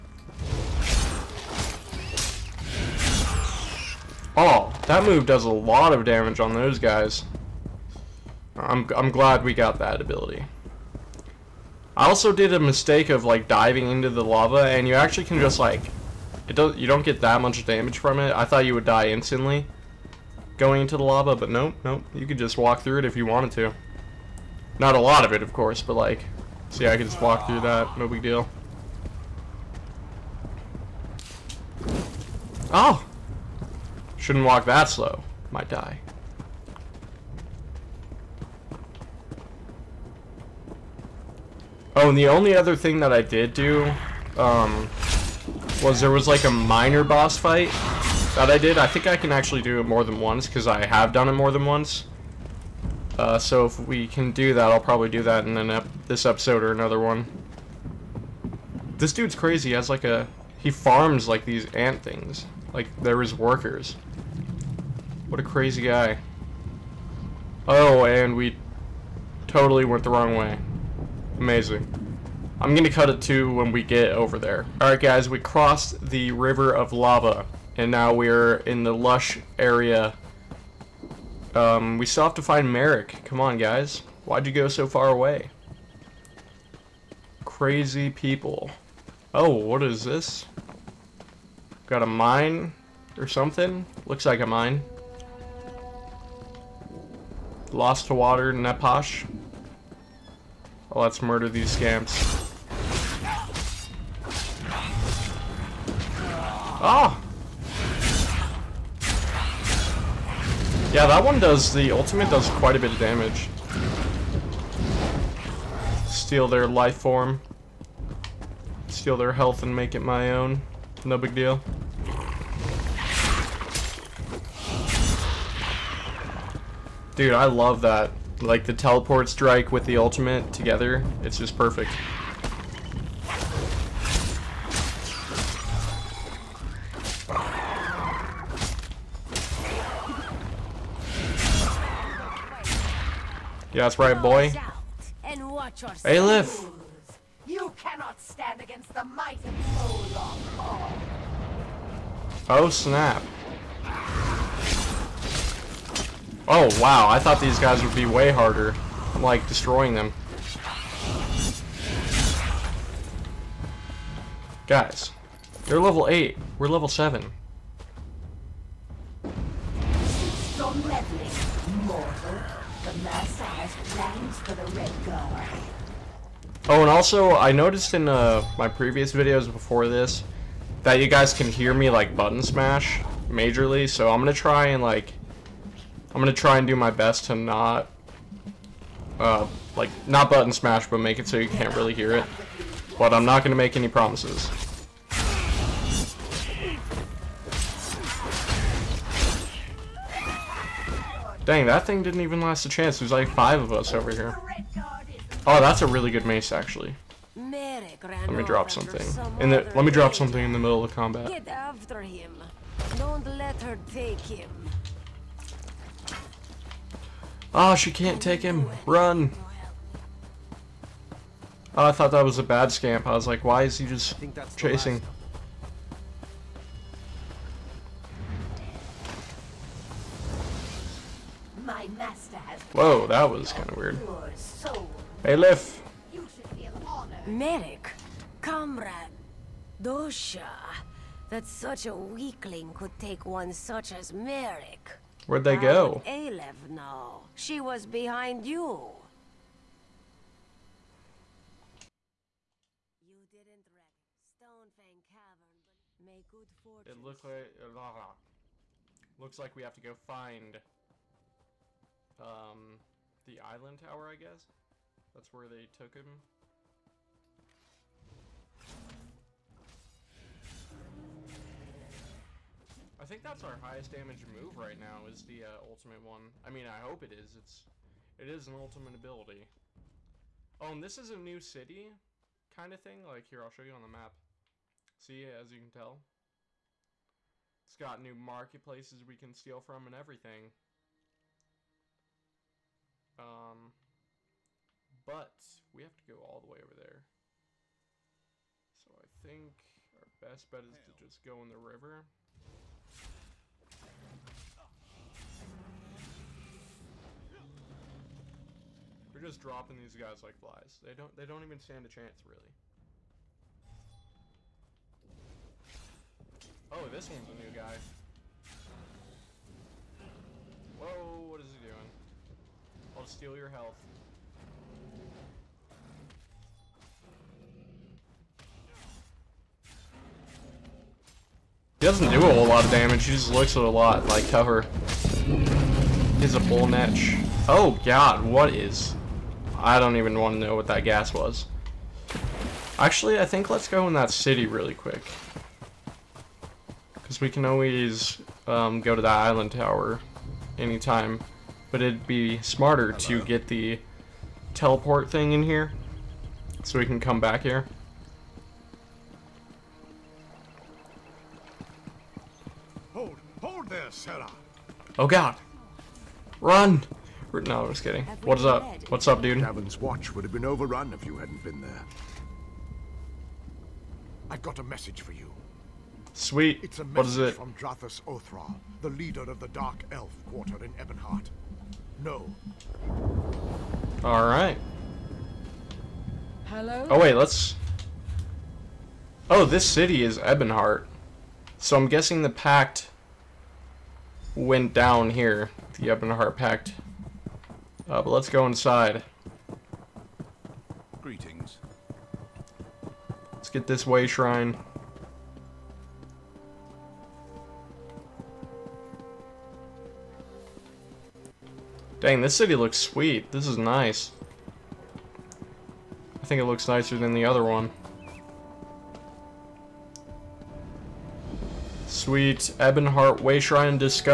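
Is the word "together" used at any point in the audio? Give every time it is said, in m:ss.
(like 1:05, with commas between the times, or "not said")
2:10.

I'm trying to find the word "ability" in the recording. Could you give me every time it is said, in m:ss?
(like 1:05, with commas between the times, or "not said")
0:09, 4:38.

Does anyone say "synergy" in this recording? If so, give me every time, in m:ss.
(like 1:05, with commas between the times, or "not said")
not said.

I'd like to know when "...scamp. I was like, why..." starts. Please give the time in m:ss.
3:42.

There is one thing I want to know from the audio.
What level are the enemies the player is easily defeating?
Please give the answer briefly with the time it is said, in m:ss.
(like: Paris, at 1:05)
8, at 2:45.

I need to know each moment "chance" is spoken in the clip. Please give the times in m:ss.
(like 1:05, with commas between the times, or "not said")
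3:22, 5:11.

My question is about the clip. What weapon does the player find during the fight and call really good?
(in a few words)
Mace.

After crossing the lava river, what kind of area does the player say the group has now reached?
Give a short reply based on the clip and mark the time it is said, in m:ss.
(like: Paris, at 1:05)
Lush area, at 1:18.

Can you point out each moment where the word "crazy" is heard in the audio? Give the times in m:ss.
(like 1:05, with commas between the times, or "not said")
0:59, 1:05, 1:27.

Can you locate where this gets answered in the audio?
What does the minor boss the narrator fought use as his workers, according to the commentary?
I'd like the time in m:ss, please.
1:01.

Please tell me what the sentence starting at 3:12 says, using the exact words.
But I'm not gonna make any promises.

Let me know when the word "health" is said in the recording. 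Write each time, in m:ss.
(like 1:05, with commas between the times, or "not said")
1:59, 5:23.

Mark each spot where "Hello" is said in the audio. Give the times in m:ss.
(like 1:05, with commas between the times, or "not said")
5:52, 6:26.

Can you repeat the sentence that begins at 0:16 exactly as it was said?
You don't get that much damage from it.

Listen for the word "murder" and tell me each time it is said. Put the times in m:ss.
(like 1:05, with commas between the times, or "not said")
1:41.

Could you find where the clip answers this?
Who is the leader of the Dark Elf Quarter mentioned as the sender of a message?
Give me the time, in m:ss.
6:17.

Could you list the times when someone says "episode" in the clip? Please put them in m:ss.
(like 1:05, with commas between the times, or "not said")
0:56.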